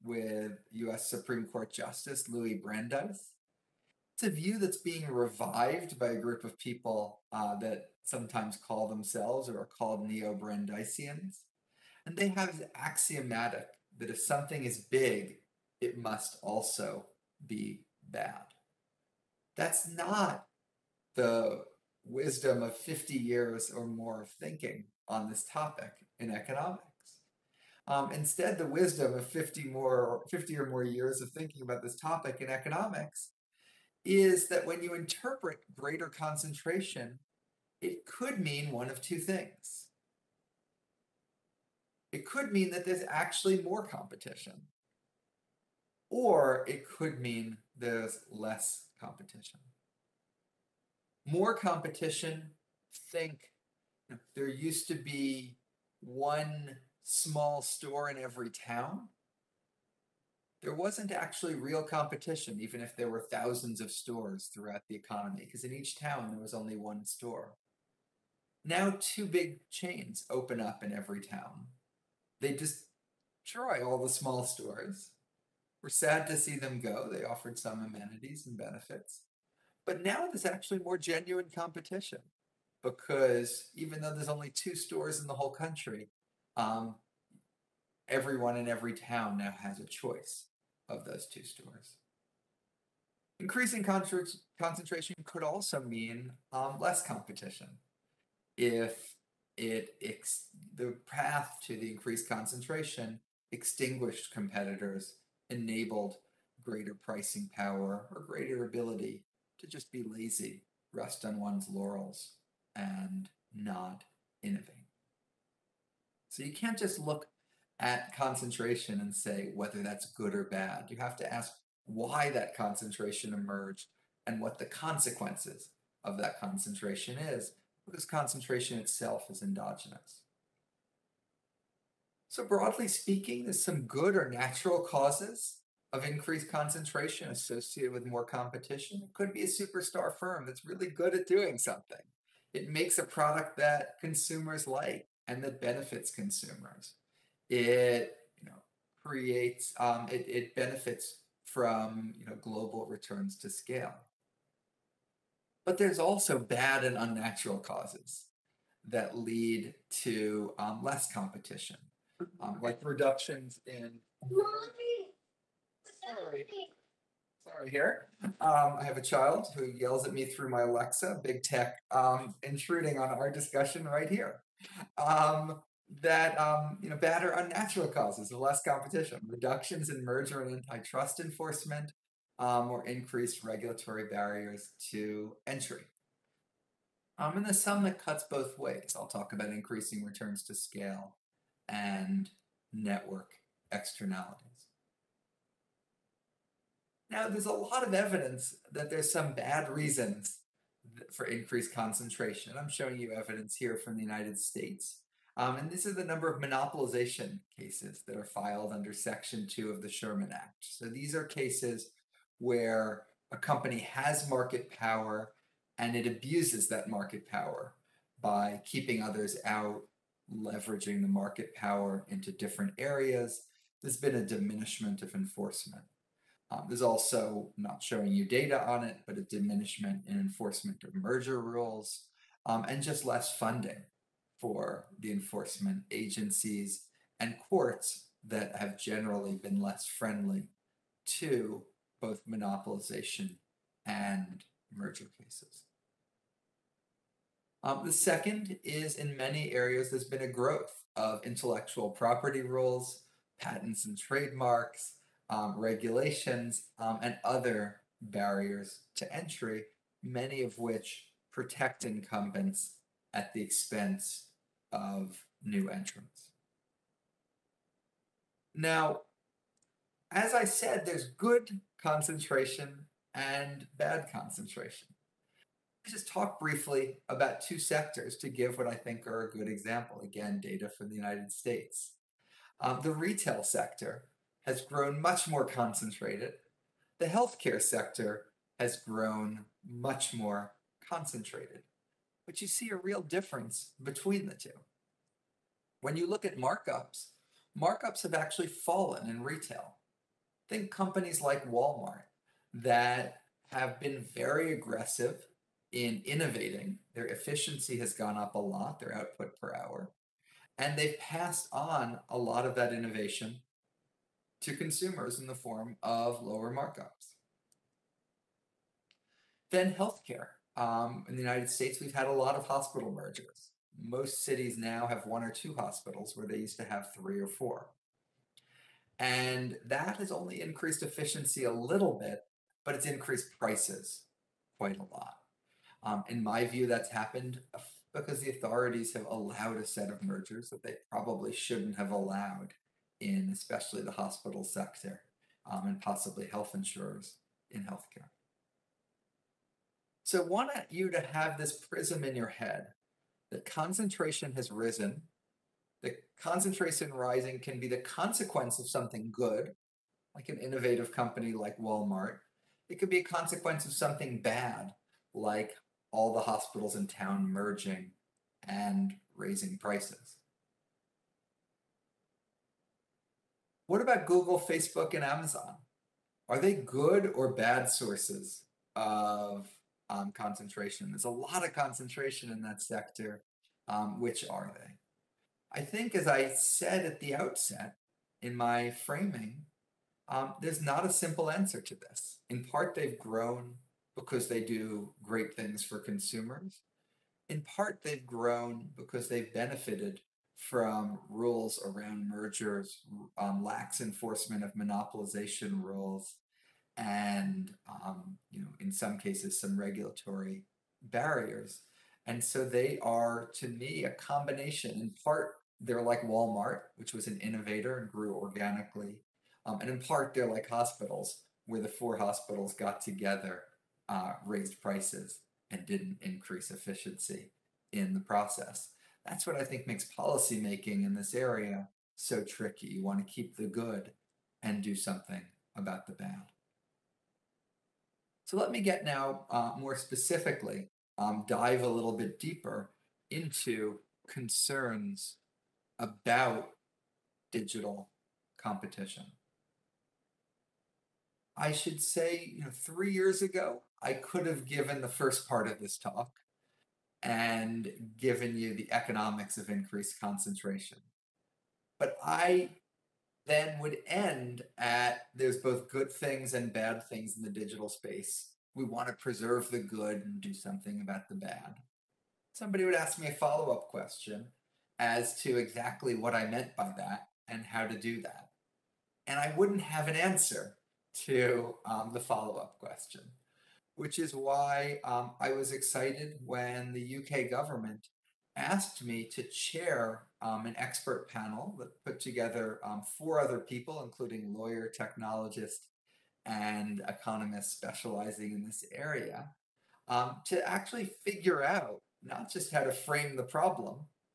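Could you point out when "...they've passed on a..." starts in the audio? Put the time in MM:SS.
05:10.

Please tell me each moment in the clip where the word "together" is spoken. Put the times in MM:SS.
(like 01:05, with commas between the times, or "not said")
07:02, 08:11.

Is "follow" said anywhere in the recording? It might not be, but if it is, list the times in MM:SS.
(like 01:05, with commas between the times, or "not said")
07:53, 08:01.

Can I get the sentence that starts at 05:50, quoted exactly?
So I want you to have this prism in your head that concentration has risen.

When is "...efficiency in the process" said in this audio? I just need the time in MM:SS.
07:06.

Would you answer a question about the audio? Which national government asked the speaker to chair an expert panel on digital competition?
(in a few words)
UK.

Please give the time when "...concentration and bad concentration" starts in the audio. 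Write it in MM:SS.
04:31.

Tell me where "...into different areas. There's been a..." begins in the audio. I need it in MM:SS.
03:42.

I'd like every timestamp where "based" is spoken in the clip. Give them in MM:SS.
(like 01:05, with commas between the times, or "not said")
not said.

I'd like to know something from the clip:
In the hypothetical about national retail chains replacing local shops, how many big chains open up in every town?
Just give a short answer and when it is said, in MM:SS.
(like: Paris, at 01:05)
2, at 01:08.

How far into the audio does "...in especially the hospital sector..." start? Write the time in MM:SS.
05:42.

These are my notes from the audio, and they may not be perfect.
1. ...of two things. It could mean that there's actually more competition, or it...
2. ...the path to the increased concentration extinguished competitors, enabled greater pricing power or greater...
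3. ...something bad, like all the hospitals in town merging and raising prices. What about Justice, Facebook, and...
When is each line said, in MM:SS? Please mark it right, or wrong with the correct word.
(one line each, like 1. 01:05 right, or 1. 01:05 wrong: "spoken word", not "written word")
1. 00:38 right
2. 01:40 right
3. 06:03 wrong: "Google", not "Justice".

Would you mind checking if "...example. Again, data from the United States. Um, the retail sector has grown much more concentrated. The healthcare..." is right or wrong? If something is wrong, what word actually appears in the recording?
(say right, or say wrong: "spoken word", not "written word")
right.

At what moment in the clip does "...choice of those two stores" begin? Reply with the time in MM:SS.
01:29.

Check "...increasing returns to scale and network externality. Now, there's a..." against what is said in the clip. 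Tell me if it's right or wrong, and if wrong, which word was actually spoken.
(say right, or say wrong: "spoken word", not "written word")
right.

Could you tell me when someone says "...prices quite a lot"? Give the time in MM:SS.
05:33.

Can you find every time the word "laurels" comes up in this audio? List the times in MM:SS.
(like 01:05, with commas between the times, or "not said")
01:51.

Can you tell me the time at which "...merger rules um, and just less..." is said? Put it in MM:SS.
03:50.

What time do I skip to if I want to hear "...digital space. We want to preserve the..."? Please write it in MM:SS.
07:47.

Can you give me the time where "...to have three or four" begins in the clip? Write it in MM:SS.
05:26.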